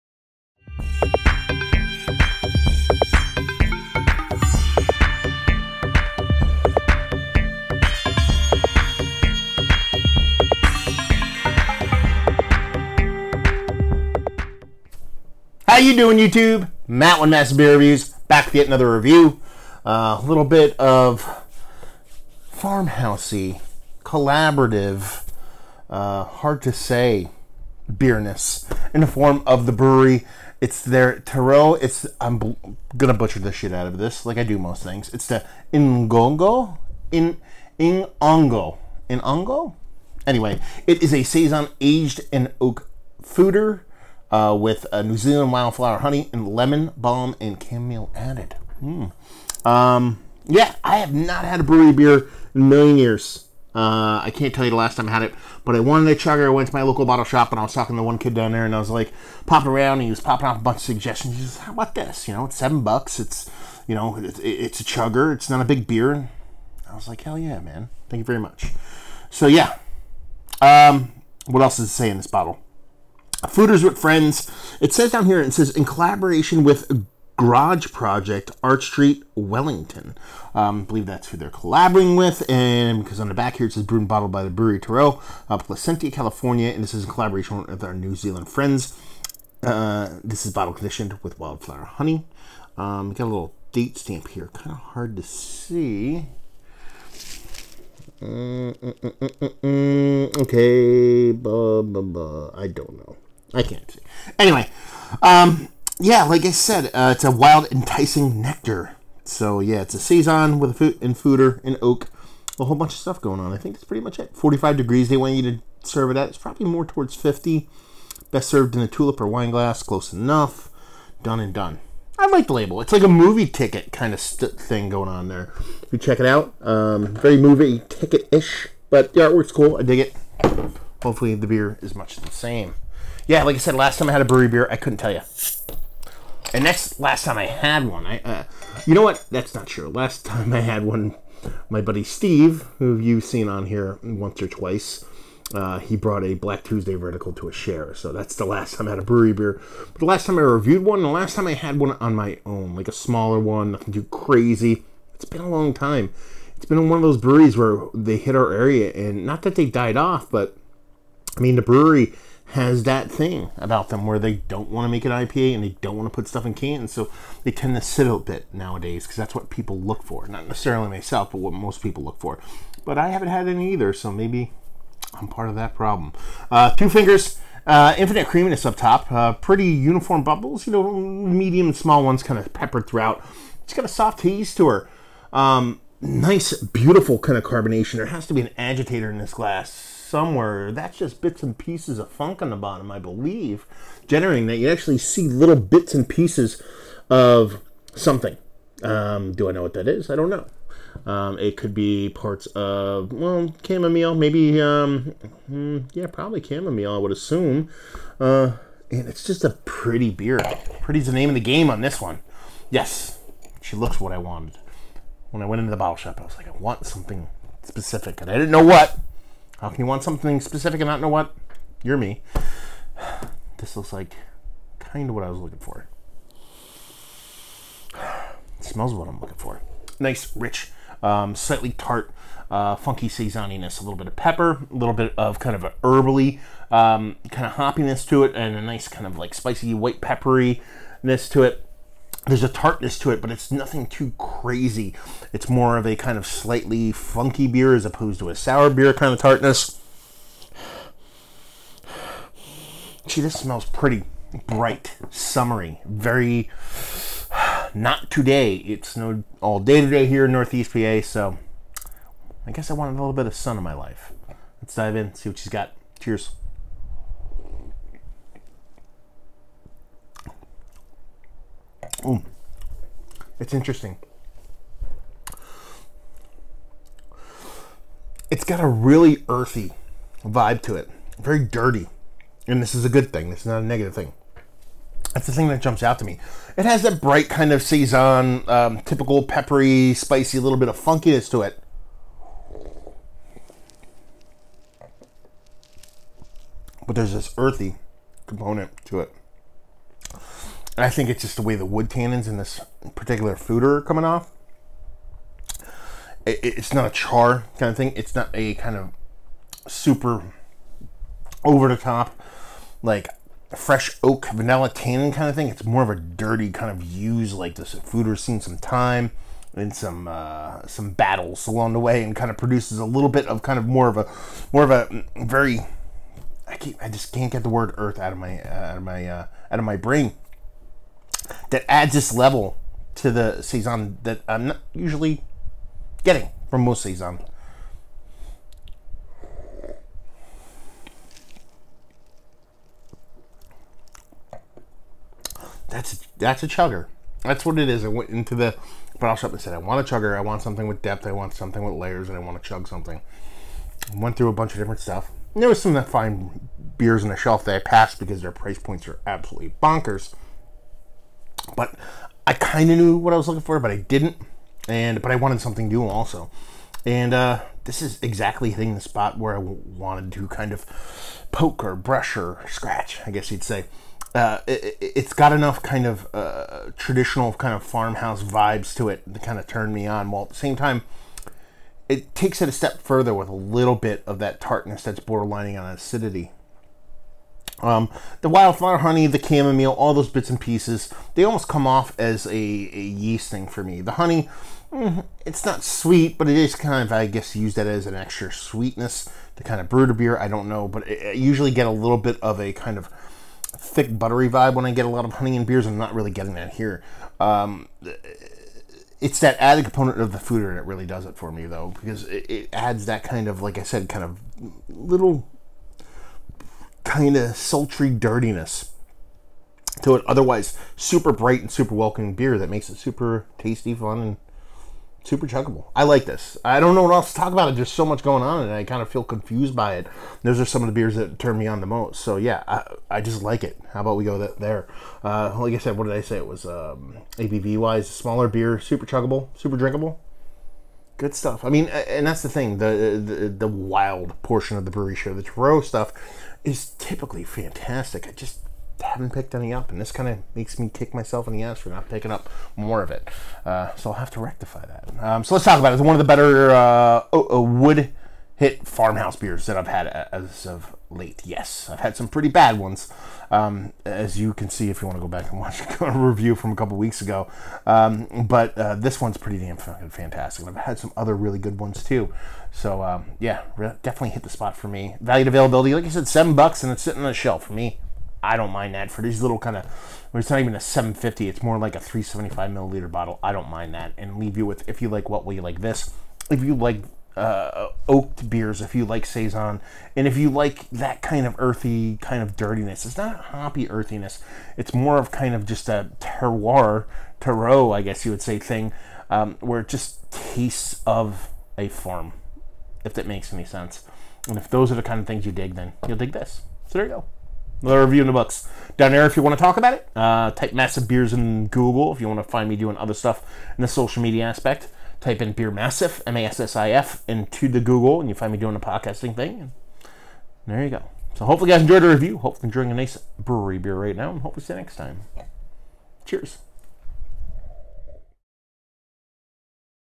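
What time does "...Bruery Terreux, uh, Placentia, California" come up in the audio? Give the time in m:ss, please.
1:24.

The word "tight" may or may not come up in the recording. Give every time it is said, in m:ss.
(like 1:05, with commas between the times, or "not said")
not said.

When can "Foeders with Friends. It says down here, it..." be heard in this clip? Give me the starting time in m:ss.
1:13.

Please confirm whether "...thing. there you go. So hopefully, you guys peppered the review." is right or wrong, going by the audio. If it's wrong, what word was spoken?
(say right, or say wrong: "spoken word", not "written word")
wrong: "enjoyed", not "peppered".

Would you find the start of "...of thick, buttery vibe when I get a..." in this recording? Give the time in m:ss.
6:42.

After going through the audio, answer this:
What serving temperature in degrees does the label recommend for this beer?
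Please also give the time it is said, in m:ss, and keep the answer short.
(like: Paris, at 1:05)
45, at 1:54.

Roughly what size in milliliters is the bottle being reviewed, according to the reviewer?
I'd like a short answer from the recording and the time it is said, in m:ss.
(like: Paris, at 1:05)
375 ml, at 8:01.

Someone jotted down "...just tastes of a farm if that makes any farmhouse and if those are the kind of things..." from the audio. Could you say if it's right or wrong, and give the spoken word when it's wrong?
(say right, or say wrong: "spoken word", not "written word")
wrong: "sense", not "farmhouse".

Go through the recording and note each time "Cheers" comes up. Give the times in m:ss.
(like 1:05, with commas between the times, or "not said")
4:25, 8:46.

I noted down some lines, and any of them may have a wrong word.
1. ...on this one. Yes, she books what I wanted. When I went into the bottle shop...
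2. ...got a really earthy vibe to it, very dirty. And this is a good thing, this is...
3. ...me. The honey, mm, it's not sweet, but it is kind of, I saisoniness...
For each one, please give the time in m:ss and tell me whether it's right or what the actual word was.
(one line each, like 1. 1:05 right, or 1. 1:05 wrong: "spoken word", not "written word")
1. 3:31 wrong: "looks", not "books"
2. 4:38 right
3. 6:33 wrong: "guess", not "saisoniness".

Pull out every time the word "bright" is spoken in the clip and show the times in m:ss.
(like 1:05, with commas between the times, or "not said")
4:14, 4:47, 7:01.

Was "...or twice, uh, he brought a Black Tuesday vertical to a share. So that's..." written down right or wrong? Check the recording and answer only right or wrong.
right.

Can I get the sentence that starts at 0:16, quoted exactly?
Matt with Mass Beer Reviews, back to yet another review.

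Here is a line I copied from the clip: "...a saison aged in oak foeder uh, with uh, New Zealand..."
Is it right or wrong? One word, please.
right.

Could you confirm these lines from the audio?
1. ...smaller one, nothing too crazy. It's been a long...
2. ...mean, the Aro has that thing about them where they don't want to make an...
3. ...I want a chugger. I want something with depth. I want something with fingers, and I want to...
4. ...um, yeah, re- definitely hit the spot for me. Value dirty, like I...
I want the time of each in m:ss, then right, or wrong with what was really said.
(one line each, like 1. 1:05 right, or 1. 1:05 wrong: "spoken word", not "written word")
1. 2:32 right
2. 2:41 wrong: "Bruery", not "Aro"
3. 5:49 wrong: "layers", not "fingers"
4. 7:52 wrong: "availability", not "dirty".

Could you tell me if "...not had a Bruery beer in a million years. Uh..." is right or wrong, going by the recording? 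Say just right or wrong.
right.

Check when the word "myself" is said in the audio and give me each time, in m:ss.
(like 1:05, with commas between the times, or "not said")
2:50, 7:30.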